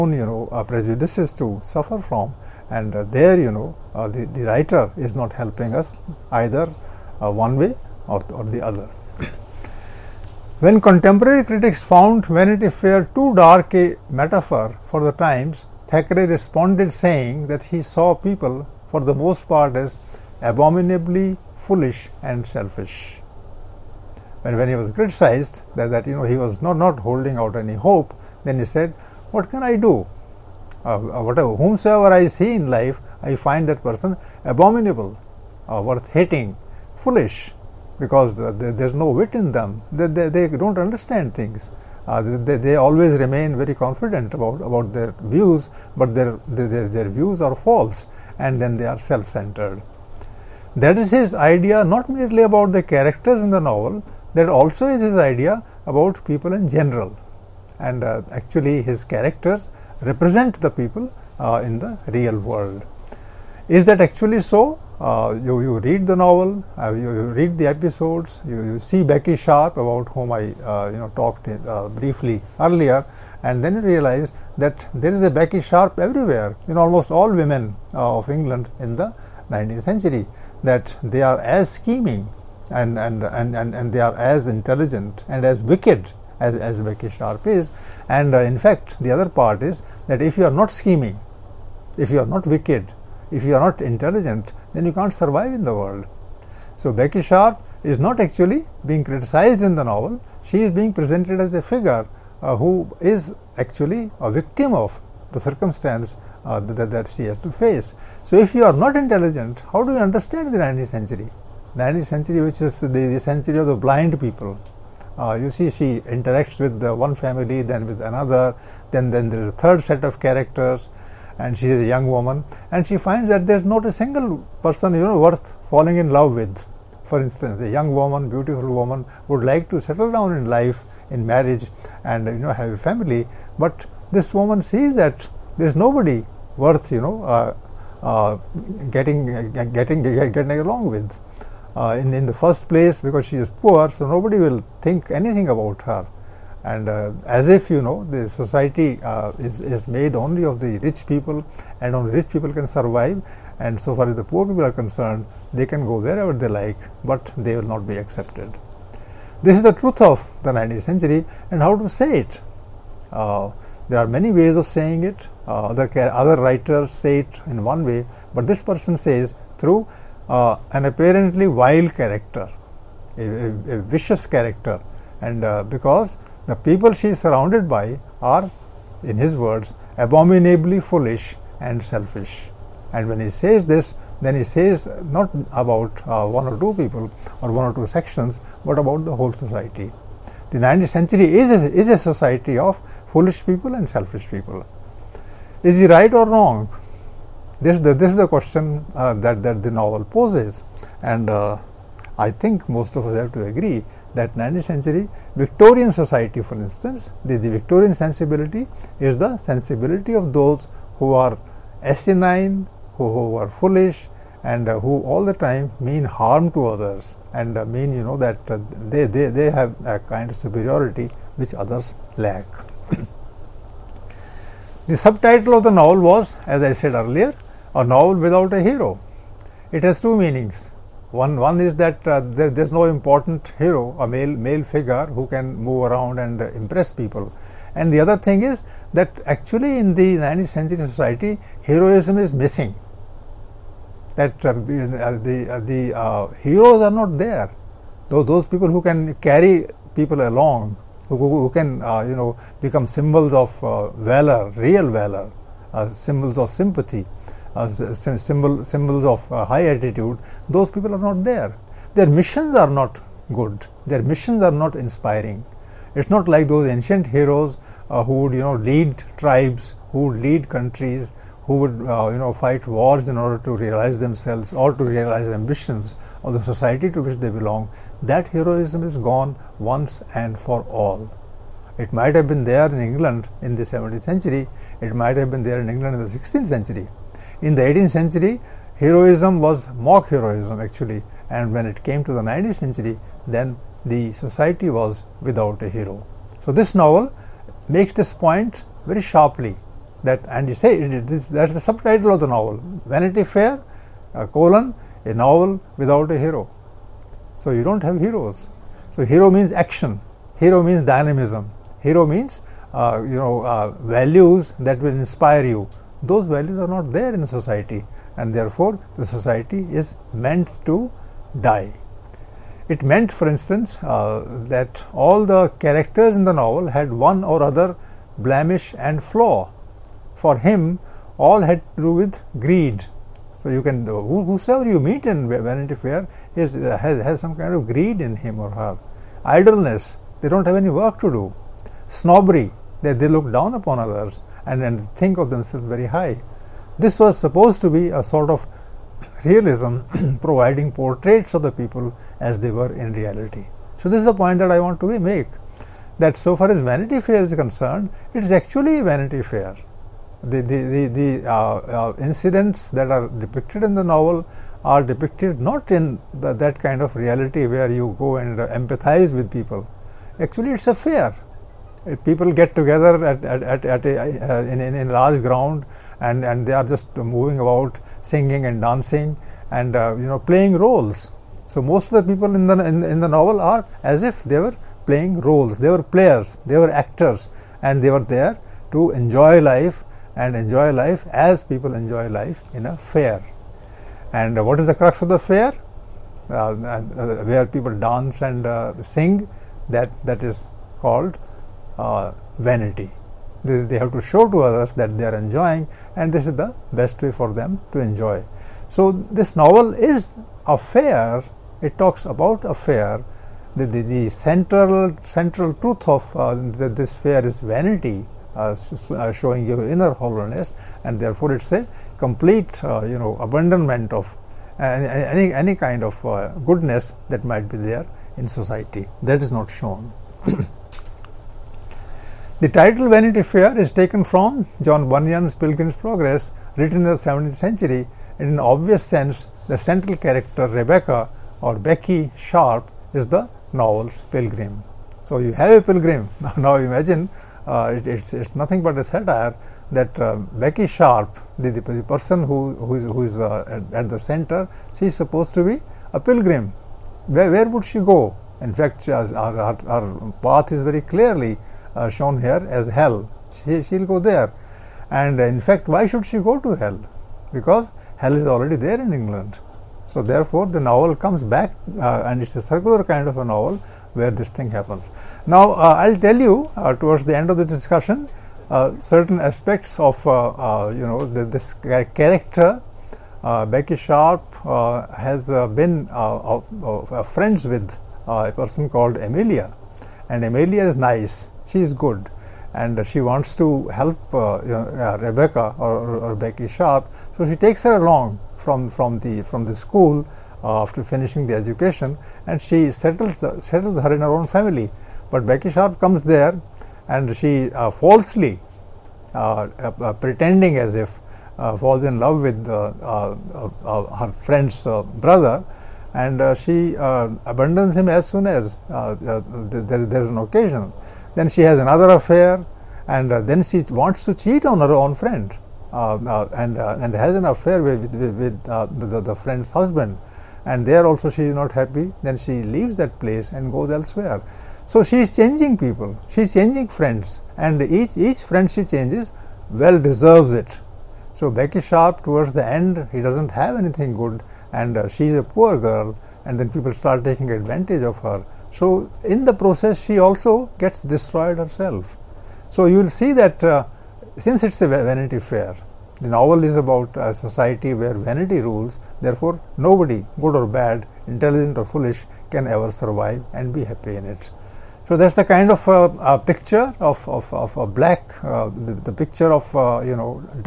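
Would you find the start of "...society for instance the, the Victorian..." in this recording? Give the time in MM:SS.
03:25.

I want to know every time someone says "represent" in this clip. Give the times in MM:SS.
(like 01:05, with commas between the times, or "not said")
01:00.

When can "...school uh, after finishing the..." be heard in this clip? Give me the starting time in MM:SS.
08:19.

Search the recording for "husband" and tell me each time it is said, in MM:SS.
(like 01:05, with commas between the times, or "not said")
08:49.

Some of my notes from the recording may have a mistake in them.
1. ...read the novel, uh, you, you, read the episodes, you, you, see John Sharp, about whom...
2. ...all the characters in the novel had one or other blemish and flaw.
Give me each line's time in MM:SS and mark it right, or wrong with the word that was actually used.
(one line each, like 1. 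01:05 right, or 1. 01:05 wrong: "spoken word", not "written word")
1. 01:05 wrong: "Becky", not "John"
2. 05:24 right.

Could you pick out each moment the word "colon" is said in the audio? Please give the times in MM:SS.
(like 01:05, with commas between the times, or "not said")
05:04.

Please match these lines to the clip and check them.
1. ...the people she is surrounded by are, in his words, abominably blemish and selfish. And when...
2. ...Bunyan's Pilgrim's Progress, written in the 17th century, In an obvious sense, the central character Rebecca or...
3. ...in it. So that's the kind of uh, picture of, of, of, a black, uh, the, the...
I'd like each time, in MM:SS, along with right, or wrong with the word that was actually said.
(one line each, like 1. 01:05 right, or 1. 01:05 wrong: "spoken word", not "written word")
1. 02:56 wrong: "foolish", not "blemish"
2. 07:14 right
3. 09:23 right.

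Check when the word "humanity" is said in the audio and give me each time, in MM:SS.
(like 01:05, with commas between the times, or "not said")
not said.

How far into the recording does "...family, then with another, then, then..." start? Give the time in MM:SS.
01:57.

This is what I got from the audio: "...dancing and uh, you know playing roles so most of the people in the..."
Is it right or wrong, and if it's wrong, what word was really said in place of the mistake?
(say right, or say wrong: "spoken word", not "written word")
right.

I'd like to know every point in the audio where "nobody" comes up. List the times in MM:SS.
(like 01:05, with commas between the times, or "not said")
02:15, 02:24, 09:19.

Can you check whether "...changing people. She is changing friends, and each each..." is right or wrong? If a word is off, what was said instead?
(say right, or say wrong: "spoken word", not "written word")
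right.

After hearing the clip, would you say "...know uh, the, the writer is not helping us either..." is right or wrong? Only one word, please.
right.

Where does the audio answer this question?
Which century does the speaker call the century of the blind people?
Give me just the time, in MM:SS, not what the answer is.
01:51.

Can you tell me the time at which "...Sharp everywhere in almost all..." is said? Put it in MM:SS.
01:15.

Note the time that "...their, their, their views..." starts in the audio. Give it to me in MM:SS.
00:46.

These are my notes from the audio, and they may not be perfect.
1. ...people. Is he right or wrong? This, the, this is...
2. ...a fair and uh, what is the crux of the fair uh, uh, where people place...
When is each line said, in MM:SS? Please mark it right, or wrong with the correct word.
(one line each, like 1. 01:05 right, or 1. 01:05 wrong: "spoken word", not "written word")
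1. 03:14 right
2. 06:32 wrong: "dance", not "place".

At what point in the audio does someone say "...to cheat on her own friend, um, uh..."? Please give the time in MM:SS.
08:44.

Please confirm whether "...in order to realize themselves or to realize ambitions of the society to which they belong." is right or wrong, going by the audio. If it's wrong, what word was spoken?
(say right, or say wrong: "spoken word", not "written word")
right.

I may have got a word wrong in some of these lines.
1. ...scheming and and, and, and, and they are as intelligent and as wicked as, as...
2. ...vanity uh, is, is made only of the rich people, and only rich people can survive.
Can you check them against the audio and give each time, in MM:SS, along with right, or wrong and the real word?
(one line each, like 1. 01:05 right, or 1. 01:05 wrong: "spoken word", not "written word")
1. 01:21 right
2. 02:28 wrong: "society", not "vanity".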